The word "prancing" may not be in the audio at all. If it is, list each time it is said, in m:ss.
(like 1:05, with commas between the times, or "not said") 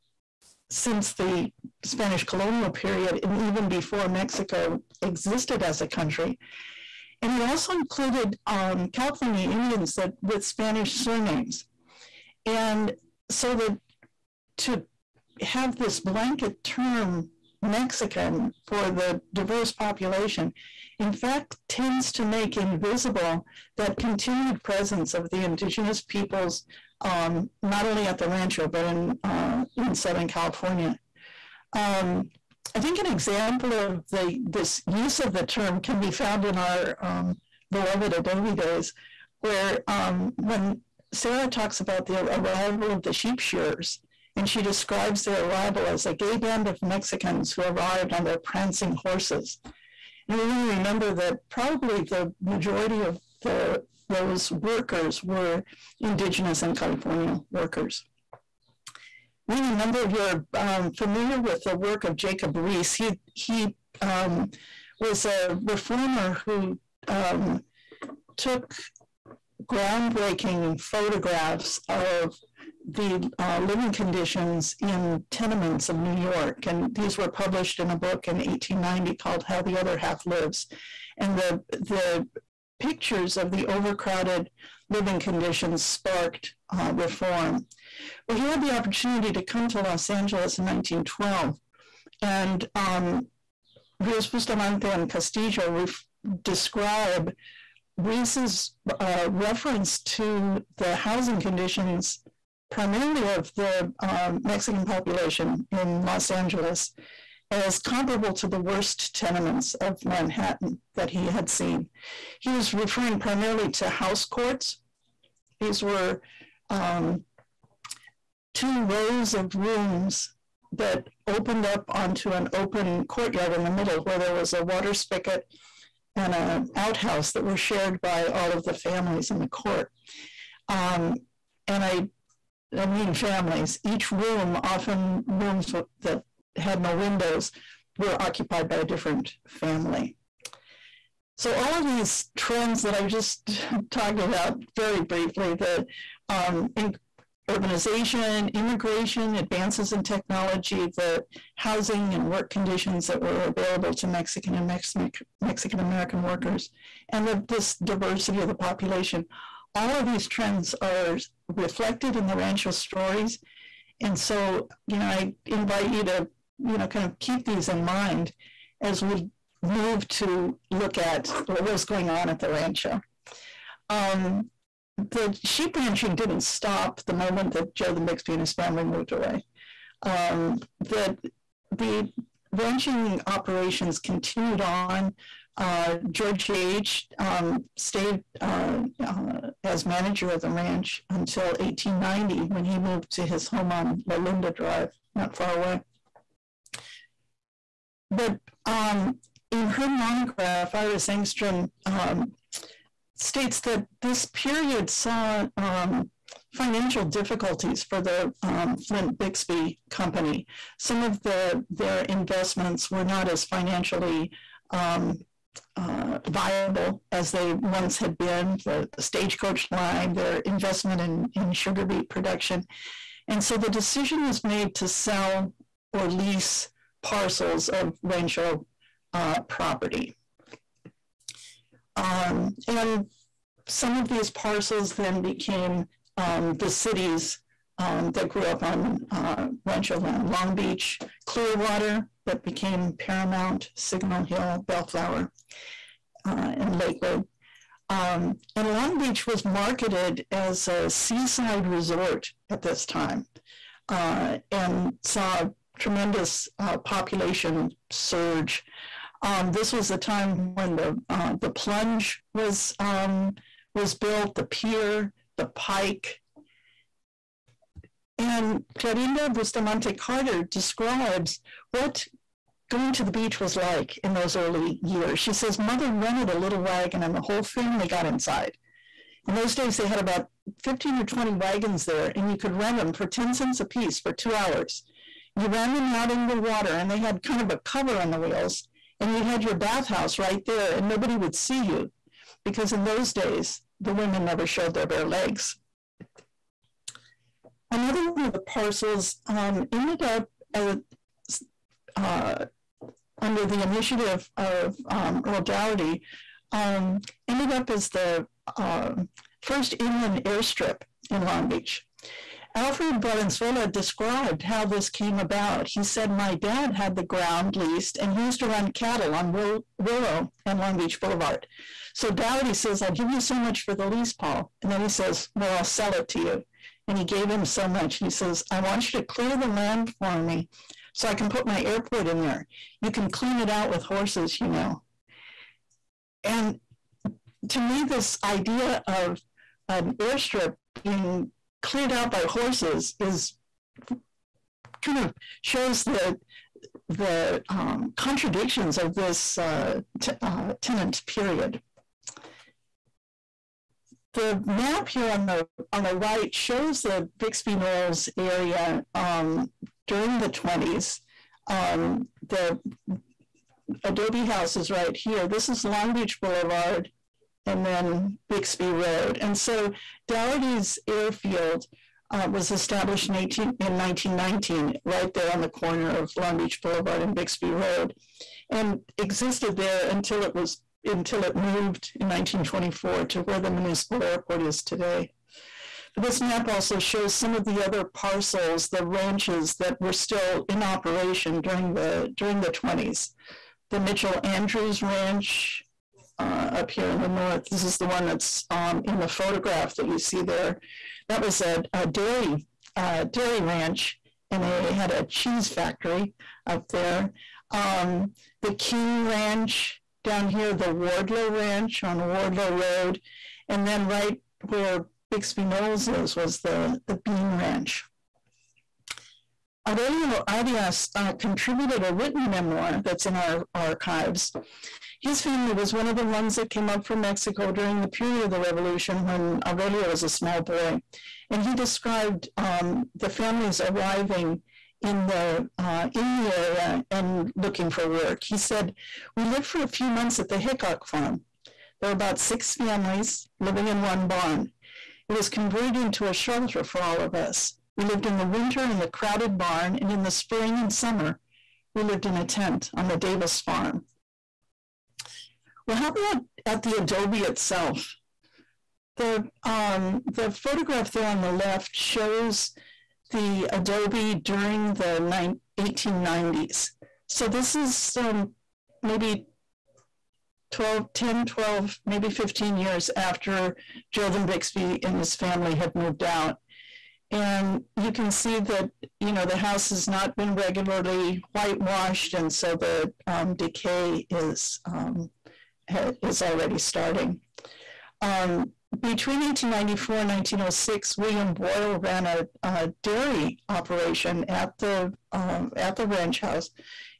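0:48.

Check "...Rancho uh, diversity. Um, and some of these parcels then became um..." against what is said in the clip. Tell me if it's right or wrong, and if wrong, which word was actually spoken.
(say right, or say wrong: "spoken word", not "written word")
wrong: "property", not "diversity".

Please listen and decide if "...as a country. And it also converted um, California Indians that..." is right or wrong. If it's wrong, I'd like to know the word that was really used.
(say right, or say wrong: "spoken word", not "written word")
wrong: "included", not "converted".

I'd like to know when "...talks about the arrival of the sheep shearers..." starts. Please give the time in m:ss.
0:41.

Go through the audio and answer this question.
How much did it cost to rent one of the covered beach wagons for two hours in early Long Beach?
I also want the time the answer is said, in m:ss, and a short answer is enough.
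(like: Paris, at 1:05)
10 cents, at 4:43.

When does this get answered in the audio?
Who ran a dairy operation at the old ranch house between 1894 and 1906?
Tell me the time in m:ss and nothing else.
8:10.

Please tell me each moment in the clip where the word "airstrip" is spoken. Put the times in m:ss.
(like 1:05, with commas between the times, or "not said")
5:10, 5:39.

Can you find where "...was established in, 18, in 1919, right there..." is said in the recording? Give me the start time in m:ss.
6:12.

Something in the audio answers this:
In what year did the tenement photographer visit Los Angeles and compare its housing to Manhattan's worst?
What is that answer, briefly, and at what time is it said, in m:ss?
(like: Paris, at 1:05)
1912, at 1:30.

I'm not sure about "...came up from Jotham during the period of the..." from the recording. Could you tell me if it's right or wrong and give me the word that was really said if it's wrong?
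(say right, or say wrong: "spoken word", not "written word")
wrong: "Mexico", not "Jotham".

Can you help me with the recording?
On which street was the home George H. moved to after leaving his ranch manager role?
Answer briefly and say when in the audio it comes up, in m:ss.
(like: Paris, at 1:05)
La Linda Drive, at 3:14.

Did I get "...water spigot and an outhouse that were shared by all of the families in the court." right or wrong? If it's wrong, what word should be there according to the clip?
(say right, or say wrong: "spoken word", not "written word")
right.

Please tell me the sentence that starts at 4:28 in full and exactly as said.
And Clarinda Bustamante Carter describes what going to the beach was like in those early years.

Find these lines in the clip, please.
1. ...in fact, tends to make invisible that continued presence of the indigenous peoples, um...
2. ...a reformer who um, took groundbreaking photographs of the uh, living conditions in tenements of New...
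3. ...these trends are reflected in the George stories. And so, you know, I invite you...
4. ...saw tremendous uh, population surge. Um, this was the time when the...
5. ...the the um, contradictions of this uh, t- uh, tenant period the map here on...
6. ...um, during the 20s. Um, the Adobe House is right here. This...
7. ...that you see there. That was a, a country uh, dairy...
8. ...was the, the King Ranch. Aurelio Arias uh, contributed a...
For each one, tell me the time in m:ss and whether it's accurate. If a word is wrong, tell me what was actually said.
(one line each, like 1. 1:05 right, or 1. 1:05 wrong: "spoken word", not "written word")
1. 0:20 right
2. 1:05 right
3. 2:40 wrong: "Rancho", not "George"
4. 4:15 right
5. 5:45 right
6. 5:58 right
7. 6:39 wrong: "dairy", not "country"
8. 6:56 wrong: "Bean", not "King".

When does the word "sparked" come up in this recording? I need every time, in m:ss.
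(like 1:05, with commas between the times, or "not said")
1:25.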